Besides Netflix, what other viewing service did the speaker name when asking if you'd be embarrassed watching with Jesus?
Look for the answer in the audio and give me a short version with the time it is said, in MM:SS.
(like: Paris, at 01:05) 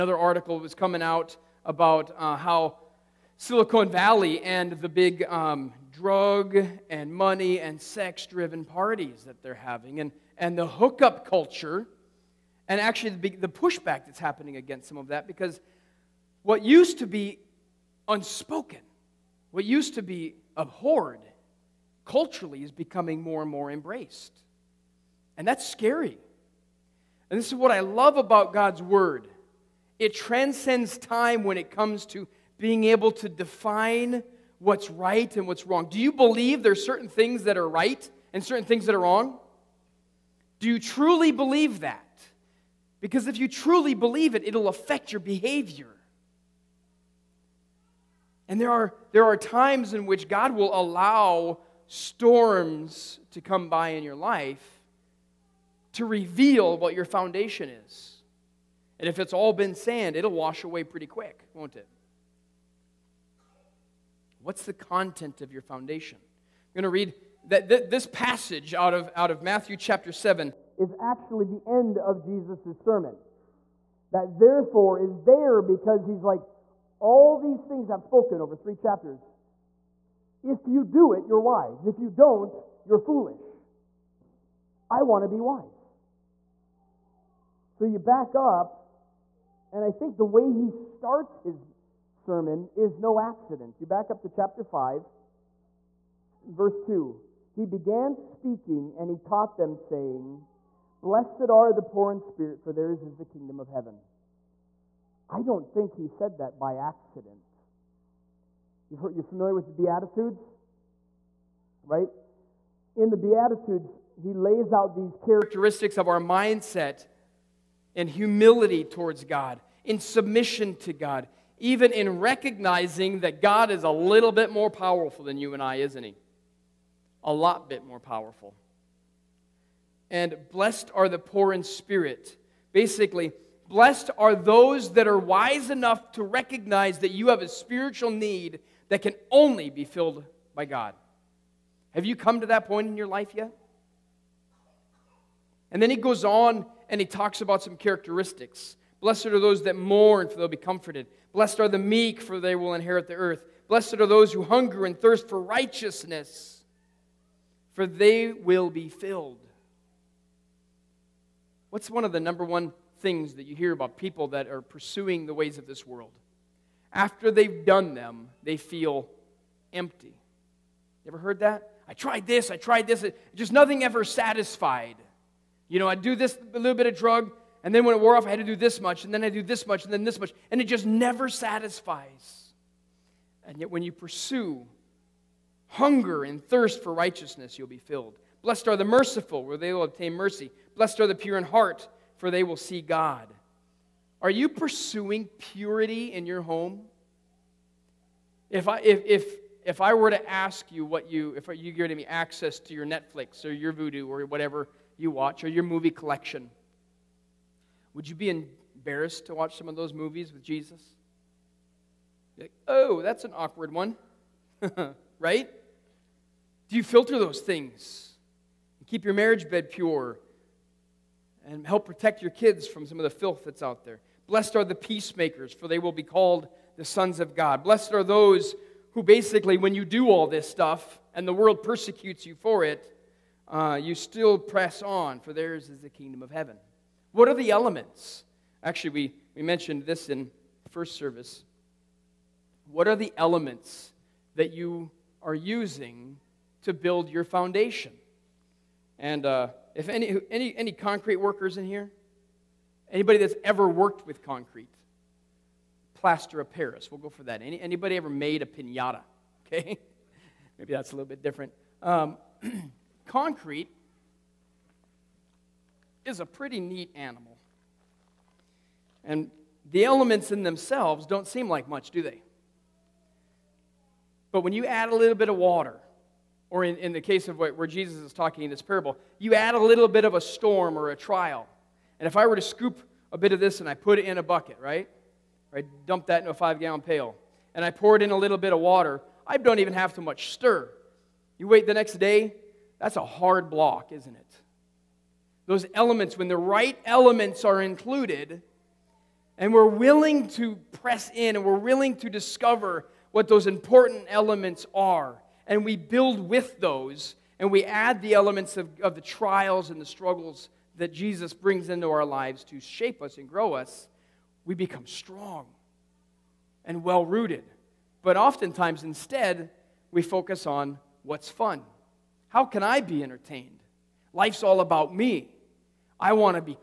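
Vudu, at 03:23.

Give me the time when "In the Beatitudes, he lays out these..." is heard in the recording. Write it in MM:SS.
01:52.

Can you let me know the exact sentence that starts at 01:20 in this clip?
If you do it, you're wise.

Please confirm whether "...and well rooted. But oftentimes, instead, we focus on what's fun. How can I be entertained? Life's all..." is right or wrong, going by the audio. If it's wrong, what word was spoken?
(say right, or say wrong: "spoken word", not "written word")
right.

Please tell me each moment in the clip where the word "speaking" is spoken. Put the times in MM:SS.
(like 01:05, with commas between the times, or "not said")
01:38.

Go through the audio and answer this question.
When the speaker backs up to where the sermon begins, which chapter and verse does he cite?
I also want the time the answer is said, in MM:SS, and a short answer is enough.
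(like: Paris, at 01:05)
Chapter 5, verse 2, at 01:34.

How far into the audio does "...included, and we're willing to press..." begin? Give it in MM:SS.
04:57.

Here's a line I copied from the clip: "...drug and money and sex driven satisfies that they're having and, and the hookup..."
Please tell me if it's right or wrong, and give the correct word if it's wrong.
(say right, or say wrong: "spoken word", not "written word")
wrong: "parties", not "satisfies".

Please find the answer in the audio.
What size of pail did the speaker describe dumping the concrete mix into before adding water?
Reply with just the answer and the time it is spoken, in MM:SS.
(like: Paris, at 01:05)
5 gallon, at 04:46.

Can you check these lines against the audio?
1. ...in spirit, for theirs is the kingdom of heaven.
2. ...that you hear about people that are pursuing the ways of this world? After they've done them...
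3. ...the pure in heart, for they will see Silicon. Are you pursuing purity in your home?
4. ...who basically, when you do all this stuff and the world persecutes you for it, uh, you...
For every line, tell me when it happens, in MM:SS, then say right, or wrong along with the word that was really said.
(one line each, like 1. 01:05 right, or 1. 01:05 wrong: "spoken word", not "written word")
1. 01:42 right
2. 02:43 right
3. 03:11 wrong: "God", not "Silicon"
4. 03:48 right.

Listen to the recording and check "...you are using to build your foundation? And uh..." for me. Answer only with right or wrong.
right.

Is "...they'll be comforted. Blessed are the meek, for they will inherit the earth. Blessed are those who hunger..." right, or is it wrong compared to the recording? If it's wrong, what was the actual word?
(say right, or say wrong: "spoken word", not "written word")
right.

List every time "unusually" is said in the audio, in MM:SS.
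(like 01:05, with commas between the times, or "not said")
not said.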